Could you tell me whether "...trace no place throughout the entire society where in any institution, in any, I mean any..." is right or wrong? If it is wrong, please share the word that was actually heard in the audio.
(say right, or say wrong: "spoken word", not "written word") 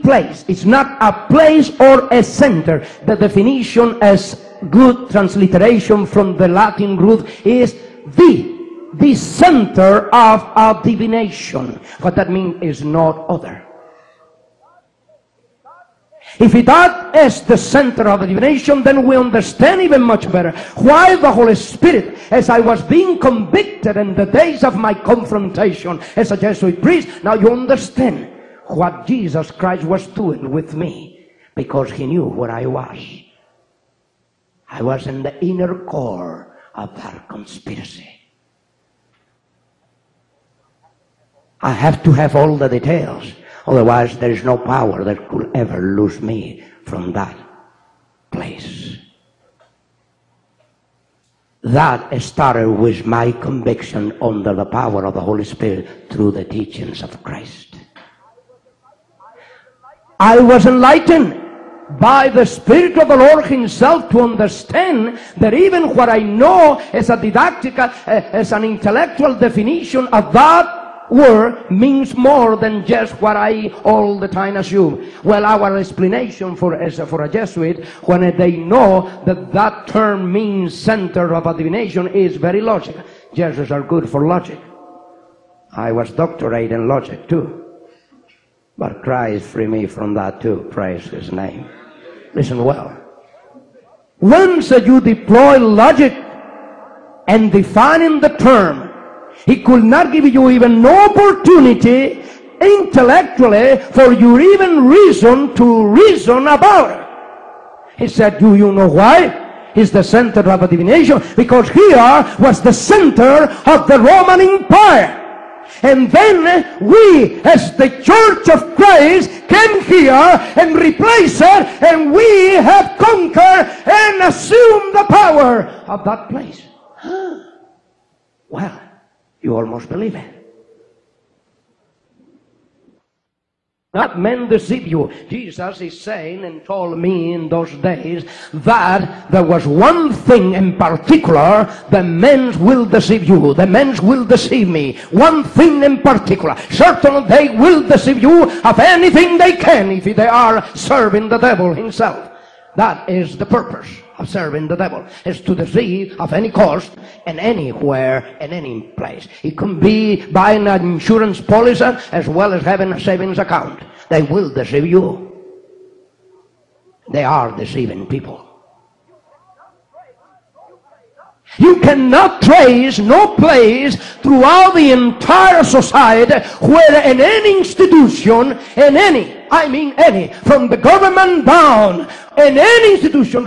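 right.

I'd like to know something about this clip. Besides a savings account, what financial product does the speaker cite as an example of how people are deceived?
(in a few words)
Insurance policy.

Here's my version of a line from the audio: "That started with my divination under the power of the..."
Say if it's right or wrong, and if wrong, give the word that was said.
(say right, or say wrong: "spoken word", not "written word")
wrong: "conviction", not "divination".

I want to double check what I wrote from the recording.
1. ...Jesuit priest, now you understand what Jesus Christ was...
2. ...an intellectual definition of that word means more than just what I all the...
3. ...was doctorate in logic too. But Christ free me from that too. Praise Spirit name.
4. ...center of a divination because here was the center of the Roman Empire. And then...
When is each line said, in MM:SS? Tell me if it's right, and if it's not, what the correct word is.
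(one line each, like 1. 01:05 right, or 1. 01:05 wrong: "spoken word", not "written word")
1. 00:26 right
2. 01:08 right
3. 01:25 wrong: "His", not "Spirit"
4. 01:50 right.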